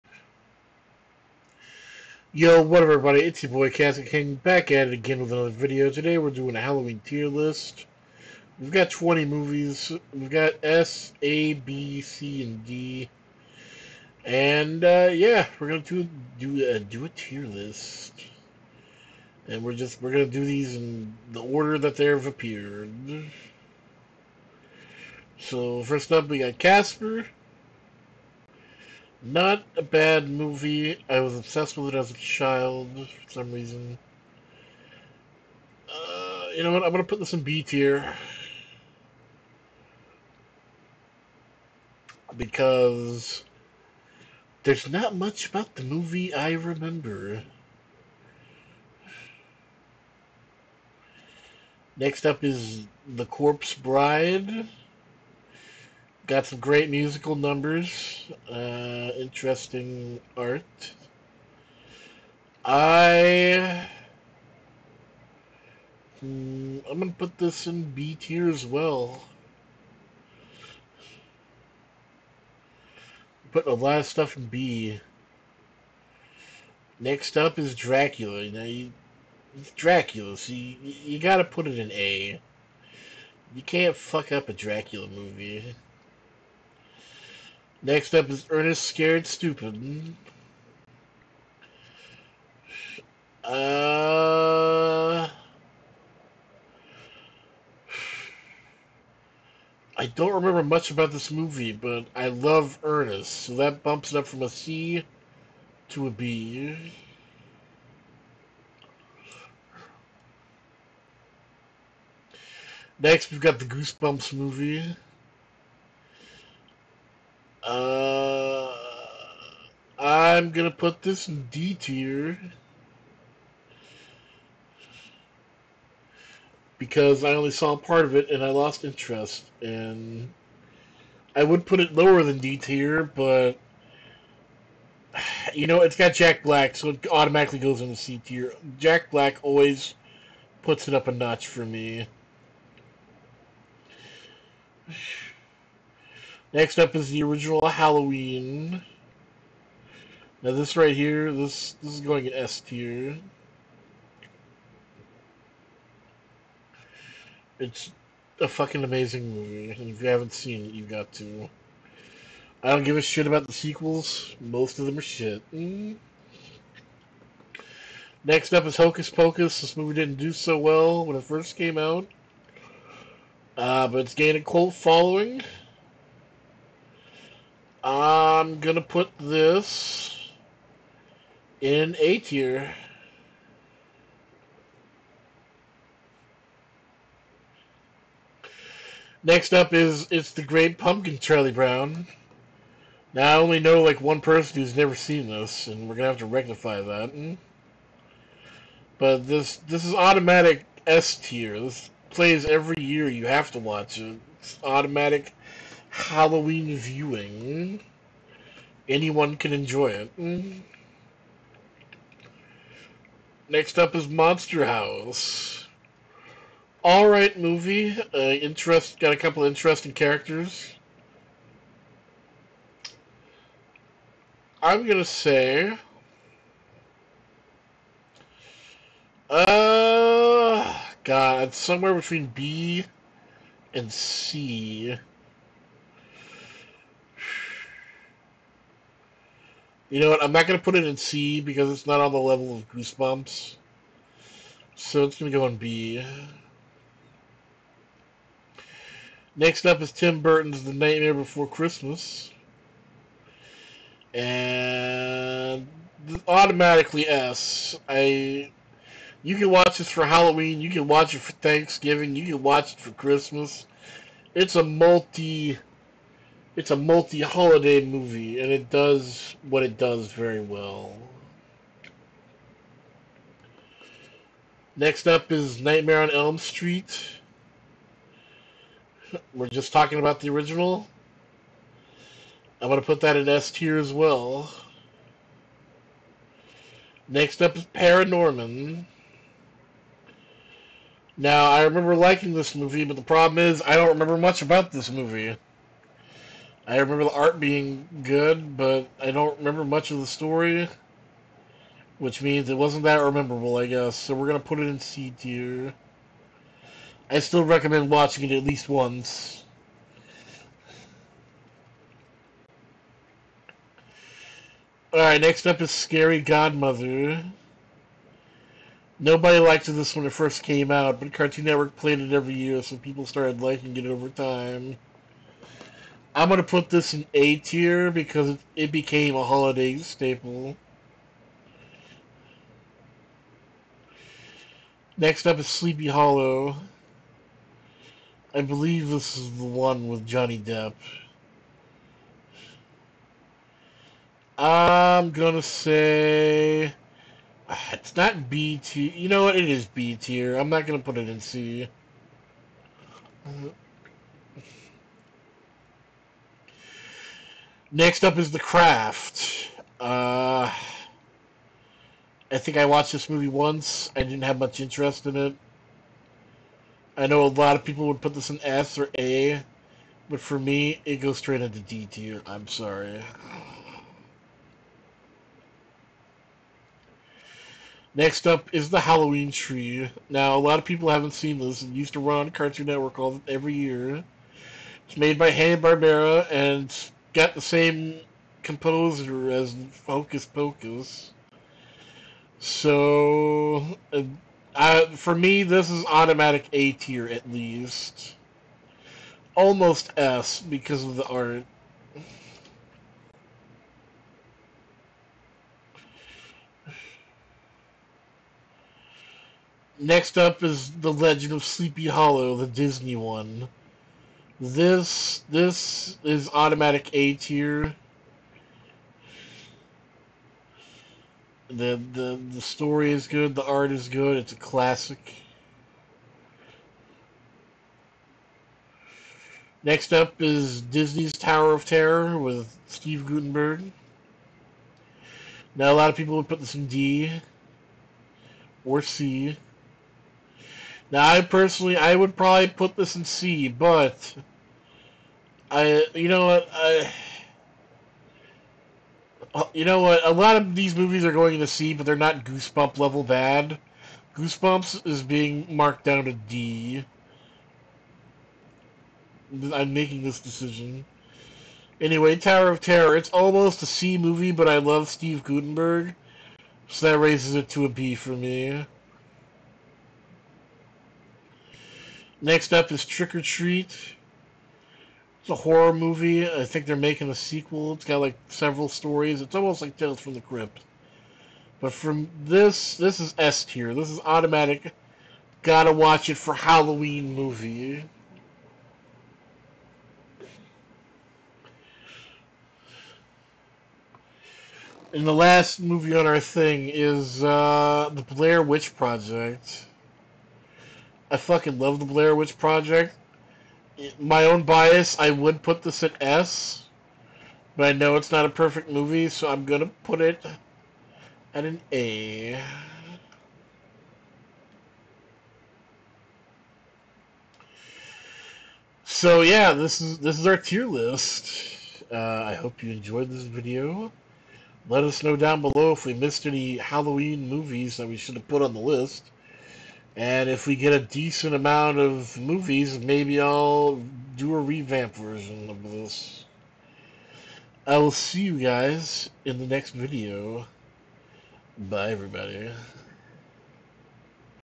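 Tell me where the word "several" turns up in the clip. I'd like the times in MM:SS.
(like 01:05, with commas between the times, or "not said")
07:58.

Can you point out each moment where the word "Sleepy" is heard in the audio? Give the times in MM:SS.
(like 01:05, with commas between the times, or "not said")
05:35, 06:51.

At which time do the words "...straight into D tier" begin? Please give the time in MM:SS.
06:11.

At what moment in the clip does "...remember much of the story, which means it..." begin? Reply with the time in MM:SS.
04:59.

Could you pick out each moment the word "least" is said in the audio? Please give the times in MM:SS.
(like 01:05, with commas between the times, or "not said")
05:08, 06:37.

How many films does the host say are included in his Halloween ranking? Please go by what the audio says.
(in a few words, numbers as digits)
20.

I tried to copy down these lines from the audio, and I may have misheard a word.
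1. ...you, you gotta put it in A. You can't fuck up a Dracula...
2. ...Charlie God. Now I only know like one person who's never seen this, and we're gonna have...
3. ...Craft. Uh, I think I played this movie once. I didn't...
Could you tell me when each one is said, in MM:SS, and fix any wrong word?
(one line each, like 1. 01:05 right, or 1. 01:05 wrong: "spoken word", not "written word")
1. 01:20 right
2. 03:11 wrong: "Brown", not "God"
3. 05:58 wrong: "watched", not "played".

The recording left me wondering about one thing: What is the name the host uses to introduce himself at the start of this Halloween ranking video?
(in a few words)
Casket King.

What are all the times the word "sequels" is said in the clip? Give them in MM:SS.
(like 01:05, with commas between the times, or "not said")
02:43, 07:57.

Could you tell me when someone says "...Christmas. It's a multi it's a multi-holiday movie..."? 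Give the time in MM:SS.
04:22.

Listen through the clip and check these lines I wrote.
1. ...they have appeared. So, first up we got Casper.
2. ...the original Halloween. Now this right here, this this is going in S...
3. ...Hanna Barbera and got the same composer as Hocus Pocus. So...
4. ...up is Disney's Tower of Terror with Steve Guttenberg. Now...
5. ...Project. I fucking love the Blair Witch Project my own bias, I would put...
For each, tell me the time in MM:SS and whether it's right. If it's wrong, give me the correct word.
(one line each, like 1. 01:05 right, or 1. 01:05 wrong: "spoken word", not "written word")
1. 00:21 right
2. 02:27 right
3. 06:25 right
4. 07:09 right
5. 08:18 right.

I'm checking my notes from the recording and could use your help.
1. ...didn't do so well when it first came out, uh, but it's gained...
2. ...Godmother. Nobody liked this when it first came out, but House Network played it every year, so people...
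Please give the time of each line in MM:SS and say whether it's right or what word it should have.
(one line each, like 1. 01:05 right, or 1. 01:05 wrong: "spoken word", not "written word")
1. 02:49 right
2. 05:16 wrong: "Cartoon", not "House".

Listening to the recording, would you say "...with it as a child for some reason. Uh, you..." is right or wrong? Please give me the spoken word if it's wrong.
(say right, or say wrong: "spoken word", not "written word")
right.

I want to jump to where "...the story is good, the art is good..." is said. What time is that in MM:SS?
07:02.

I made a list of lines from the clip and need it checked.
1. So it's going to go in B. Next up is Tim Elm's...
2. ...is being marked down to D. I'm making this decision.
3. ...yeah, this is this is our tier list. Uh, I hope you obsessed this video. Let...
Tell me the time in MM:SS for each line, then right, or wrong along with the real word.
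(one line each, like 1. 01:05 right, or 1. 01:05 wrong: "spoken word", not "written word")
1. 04:04 wrong: "Burton", not "Elm"
2. 07:34 right
3. 08:39 wrong: "enjoyed", not "obsessed".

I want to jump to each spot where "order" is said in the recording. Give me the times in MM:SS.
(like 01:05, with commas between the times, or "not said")
00:21.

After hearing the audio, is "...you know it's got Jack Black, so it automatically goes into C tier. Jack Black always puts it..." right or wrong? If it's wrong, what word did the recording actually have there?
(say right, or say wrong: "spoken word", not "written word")
right.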